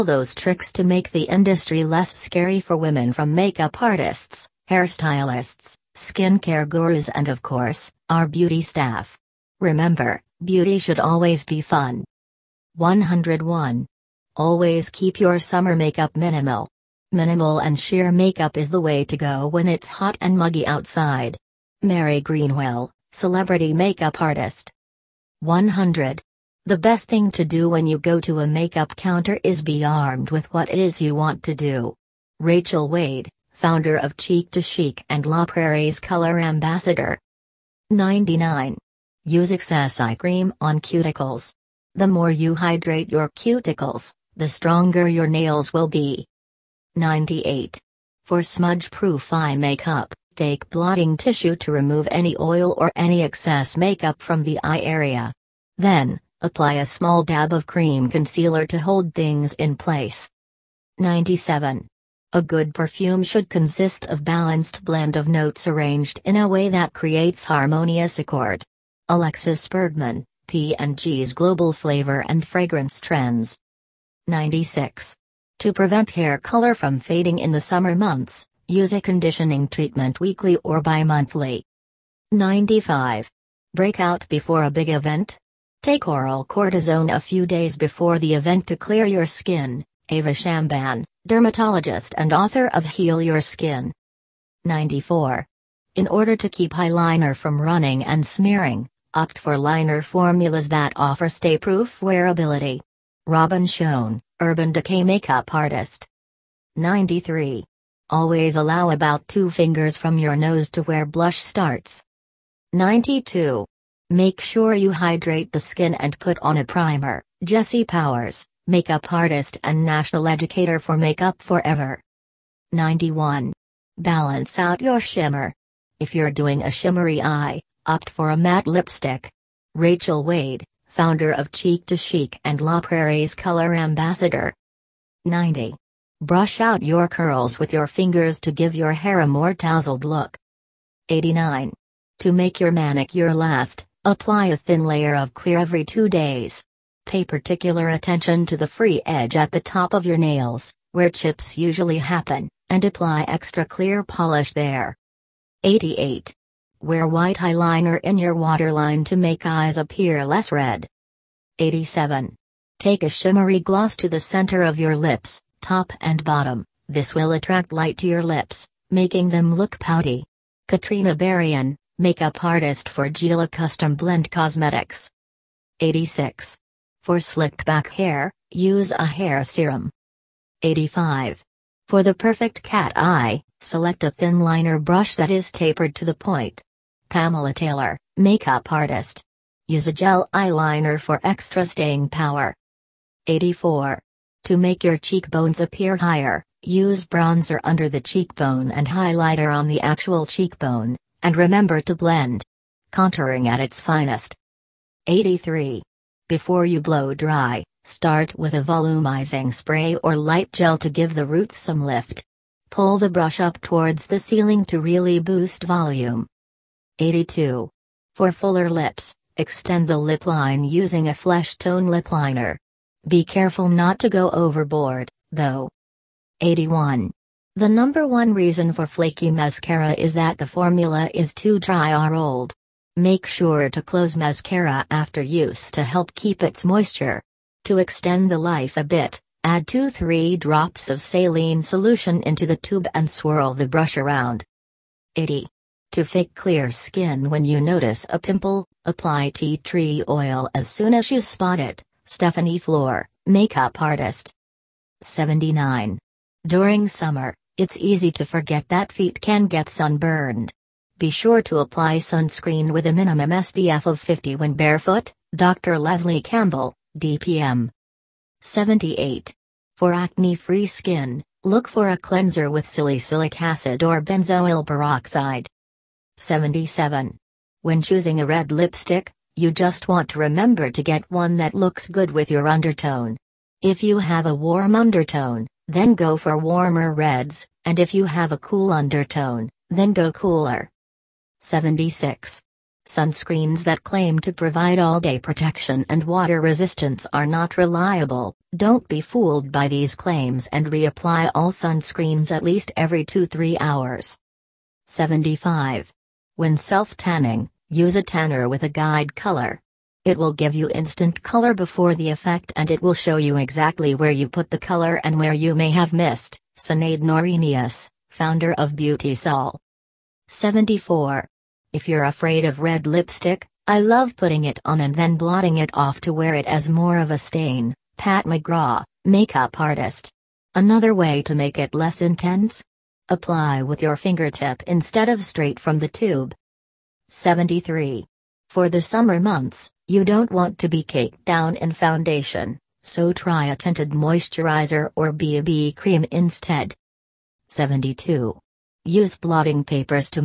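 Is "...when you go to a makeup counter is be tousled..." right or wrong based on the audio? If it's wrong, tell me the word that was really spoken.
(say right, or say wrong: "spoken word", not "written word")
wrong: "armed", not "tousled".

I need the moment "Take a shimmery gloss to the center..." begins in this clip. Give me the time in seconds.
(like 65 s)
162 s.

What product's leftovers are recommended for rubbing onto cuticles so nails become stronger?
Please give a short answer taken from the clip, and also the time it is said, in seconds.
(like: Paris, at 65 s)
Eye cream, at 39 s.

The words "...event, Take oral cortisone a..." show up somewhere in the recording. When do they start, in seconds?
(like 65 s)
84 s.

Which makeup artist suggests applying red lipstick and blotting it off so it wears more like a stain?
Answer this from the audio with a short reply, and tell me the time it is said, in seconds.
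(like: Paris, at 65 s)
Pat McGrath, at 327 s.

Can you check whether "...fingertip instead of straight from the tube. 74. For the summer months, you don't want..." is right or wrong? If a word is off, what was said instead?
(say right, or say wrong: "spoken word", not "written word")
wrong: "73", not "74".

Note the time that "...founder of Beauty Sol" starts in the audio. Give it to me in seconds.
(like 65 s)
318 s.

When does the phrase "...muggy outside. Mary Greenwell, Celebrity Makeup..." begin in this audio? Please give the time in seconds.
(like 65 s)
20 s.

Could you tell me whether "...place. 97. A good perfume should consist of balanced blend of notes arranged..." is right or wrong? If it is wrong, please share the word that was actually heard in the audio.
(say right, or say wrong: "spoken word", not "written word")
right.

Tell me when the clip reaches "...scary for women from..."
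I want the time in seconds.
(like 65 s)
2 s.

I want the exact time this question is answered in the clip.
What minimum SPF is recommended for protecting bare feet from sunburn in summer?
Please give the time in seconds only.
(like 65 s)
263 s.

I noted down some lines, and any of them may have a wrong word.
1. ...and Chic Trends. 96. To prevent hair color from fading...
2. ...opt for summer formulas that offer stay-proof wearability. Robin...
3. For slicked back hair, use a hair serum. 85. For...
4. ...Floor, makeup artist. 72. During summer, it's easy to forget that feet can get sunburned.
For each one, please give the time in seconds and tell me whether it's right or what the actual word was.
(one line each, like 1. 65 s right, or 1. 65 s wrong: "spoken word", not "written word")
1. 72 s wrong: "Fragrance", not "Chic"
2. 99 s wrong: "liner", not "summer"
3. 177 s right
4. 252 s wrong: "79", not "72".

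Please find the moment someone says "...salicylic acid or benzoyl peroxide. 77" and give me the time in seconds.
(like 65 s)
272 s.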